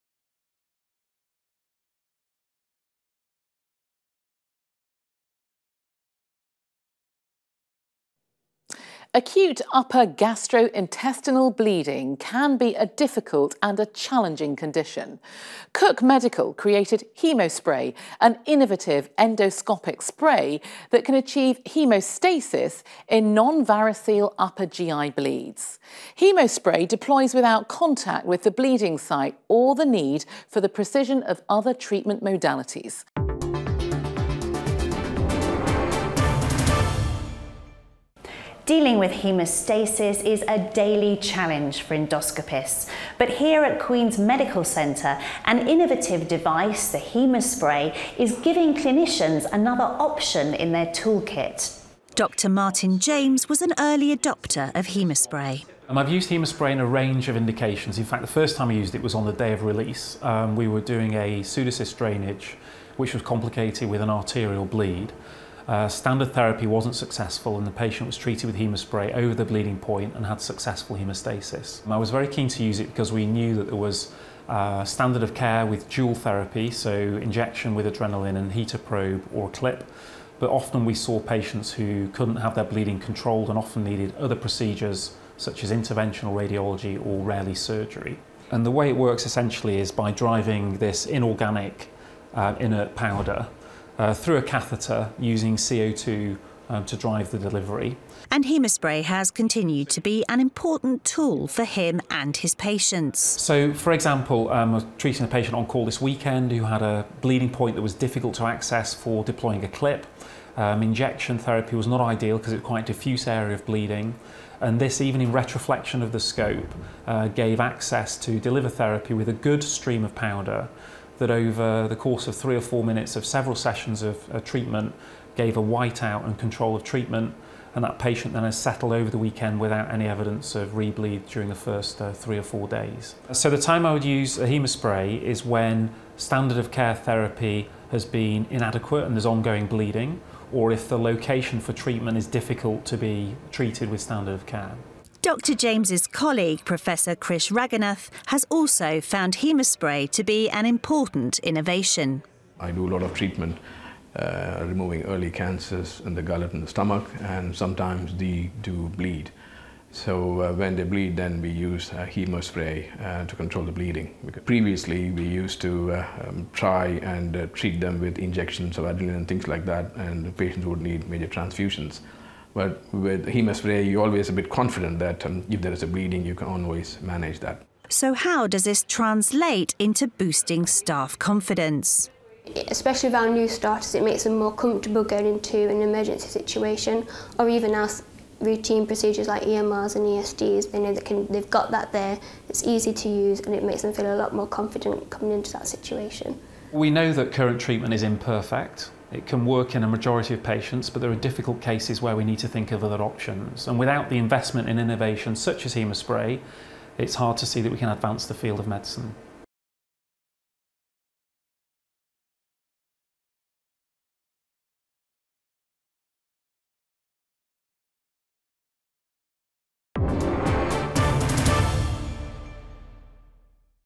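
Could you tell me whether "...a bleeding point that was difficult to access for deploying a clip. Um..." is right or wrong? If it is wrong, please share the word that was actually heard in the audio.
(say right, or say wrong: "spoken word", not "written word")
right.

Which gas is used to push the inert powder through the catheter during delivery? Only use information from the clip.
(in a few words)
CO2.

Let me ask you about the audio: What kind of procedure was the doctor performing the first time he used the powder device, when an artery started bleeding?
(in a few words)
pseudocyst drainage.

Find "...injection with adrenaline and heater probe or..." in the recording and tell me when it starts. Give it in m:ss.
1:16.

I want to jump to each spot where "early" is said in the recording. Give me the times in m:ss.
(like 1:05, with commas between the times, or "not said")
0:53, 2:35.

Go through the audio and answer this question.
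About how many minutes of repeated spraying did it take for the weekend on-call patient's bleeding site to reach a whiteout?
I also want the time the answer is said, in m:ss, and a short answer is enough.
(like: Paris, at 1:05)
3 or 4 minutes, at 2:02.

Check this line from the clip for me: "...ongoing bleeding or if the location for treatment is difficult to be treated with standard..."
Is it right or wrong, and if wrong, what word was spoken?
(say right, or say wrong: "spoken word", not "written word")
right.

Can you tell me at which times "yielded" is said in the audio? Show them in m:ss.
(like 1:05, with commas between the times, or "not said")
not said.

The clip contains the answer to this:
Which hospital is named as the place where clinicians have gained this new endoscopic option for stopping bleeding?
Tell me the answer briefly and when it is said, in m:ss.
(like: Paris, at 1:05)
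Queen's Medical Centre, at 0:43.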